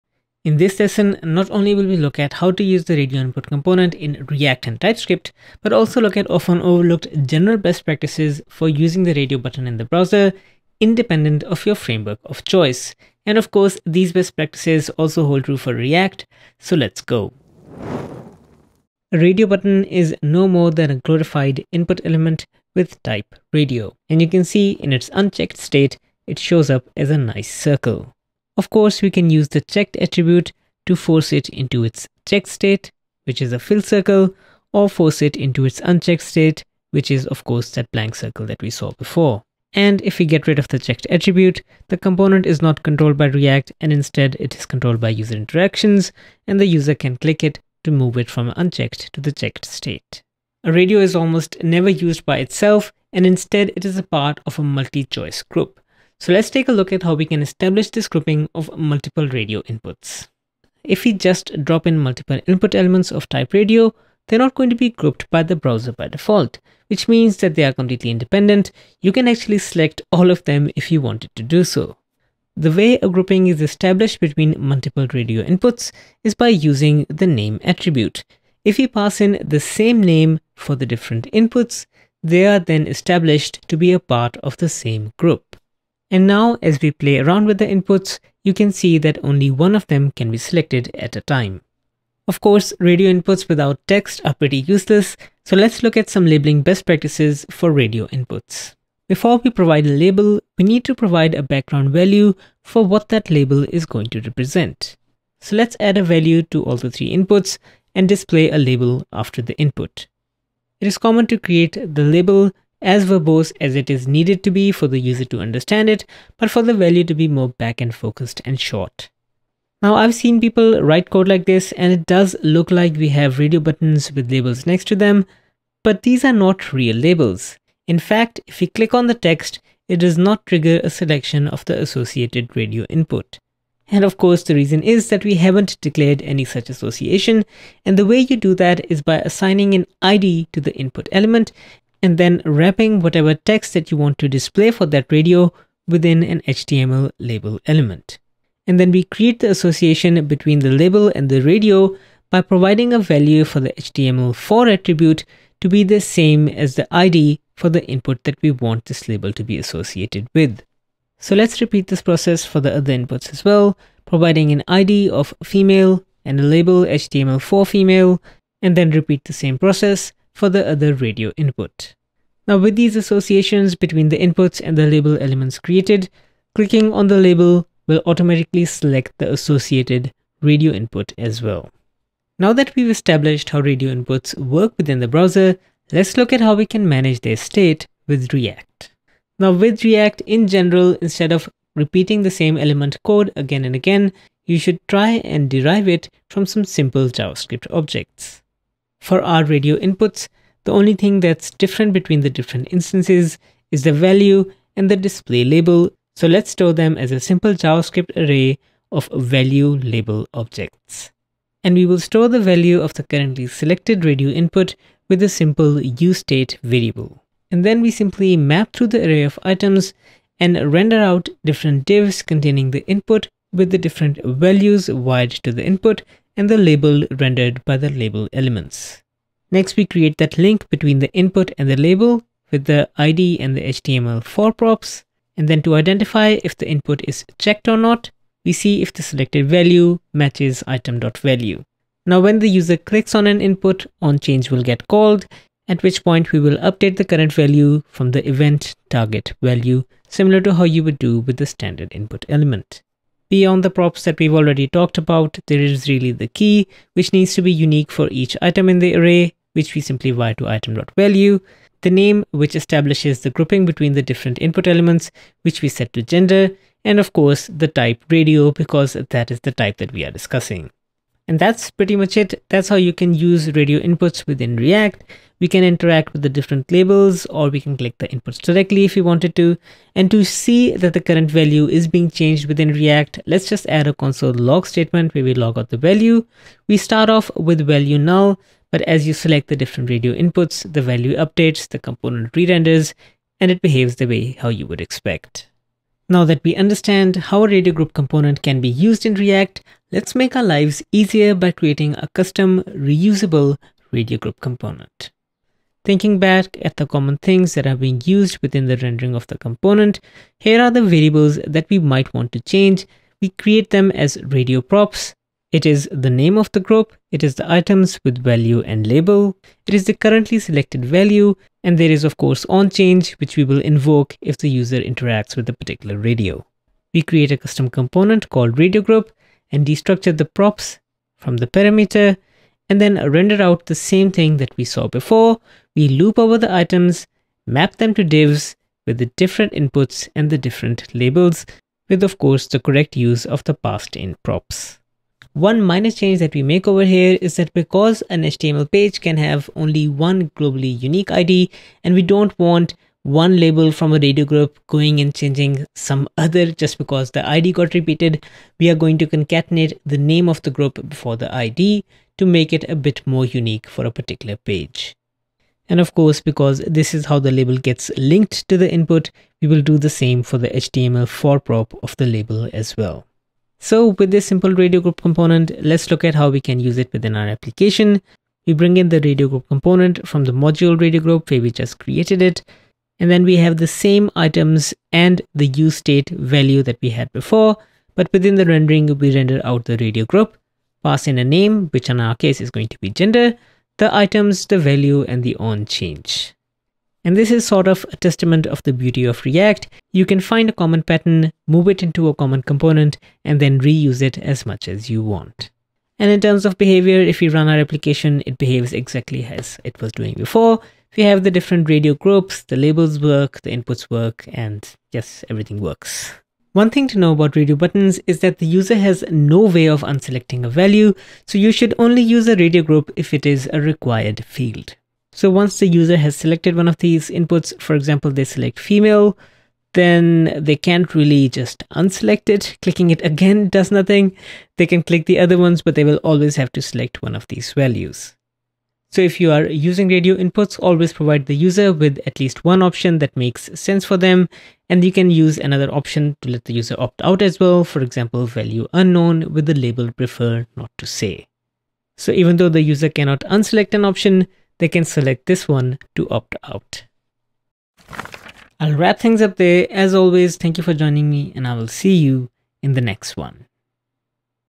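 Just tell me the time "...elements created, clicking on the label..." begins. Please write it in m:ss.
2:55.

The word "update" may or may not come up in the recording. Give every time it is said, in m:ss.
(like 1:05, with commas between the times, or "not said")
4:06, 4:51.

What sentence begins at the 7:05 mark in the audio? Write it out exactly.
So once the user has selected one of these inputs, for example, they select female, then they can't really just unselect it.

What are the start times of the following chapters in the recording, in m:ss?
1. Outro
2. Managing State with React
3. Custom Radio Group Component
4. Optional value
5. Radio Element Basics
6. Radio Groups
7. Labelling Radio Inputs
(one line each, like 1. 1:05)
1. 7:37
2. 3:02
3. 4:57
4. 6:56
5. 0:20
6. 0:50
7. 1:32.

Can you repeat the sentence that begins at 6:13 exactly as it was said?
So with this simple radio group component, let's look at how we can use it within our application.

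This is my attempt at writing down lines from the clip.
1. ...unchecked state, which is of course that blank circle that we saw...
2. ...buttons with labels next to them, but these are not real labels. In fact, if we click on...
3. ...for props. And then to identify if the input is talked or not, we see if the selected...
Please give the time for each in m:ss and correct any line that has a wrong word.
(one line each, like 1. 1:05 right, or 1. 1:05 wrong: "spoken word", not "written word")
1. 0:35 right
2. 2:03 right
3. 3:54 wrong: "checked", not "talked".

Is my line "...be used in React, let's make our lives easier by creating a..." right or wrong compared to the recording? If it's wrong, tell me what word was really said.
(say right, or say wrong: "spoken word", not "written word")
right.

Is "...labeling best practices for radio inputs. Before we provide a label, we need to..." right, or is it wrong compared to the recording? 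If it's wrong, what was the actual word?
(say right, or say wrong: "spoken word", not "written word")
right.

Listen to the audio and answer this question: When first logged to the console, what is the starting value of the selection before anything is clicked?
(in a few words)
null.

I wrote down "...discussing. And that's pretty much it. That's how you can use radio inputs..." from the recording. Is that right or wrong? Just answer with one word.
right.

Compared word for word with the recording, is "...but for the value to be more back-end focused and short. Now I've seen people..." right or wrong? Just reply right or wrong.
right.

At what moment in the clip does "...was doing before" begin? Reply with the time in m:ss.
6:49.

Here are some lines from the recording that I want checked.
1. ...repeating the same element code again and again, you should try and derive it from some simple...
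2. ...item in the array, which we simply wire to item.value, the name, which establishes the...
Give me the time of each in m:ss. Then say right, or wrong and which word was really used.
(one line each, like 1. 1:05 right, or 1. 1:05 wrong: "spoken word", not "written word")
1. 3:11 right
2. 4:18 right.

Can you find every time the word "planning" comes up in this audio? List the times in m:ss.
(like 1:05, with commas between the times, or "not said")
not said.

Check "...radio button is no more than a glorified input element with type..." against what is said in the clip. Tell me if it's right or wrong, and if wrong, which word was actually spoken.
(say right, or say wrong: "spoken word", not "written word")
right.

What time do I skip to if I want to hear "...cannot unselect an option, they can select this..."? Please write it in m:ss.
7:32.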